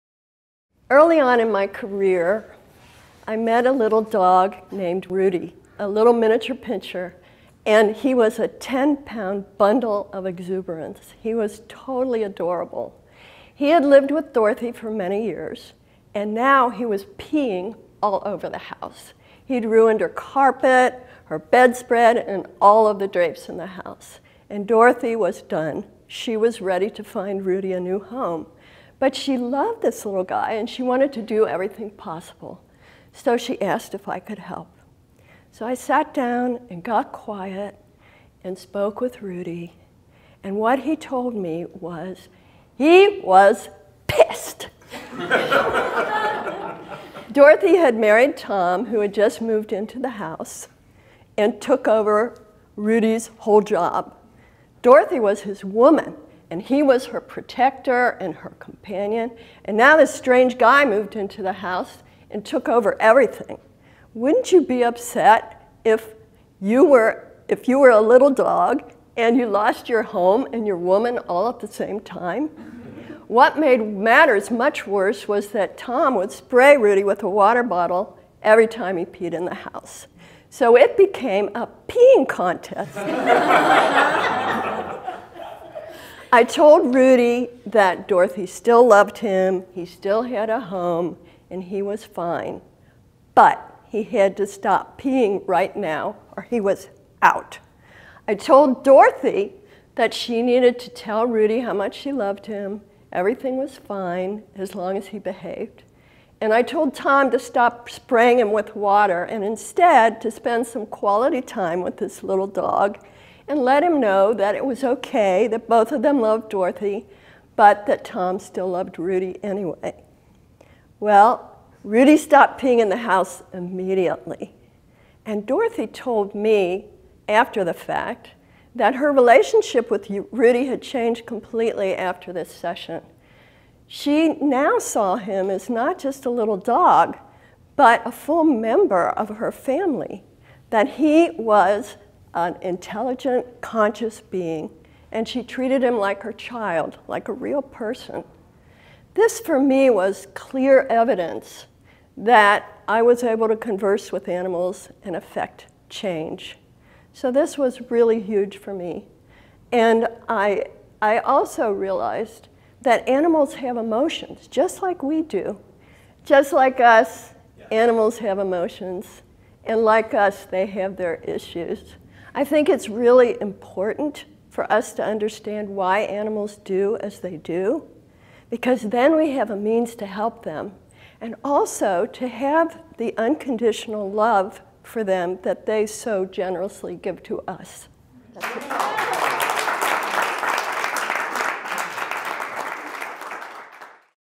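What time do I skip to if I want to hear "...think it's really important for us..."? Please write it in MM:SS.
02:52.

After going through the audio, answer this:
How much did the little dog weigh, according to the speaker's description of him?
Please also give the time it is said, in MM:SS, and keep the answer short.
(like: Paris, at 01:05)
10 pounds, at 00:08.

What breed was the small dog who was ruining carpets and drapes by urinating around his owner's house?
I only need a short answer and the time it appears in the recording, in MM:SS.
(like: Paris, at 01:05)
Miniature pinscher, at 00:06.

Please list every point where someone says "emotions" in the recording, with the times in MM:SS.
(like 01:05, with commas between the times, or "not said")
02:43, 02:48.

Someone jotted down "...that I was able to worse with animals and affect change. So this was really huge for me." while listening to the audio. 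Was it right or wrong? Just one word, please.
wrong.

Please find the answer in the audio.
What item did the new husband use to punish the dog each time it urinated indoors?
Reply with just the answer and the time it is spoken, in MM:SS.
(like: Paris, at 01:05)
Water bottle, at 01:17.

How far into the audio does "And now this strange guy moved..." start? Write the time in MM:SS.
00:59.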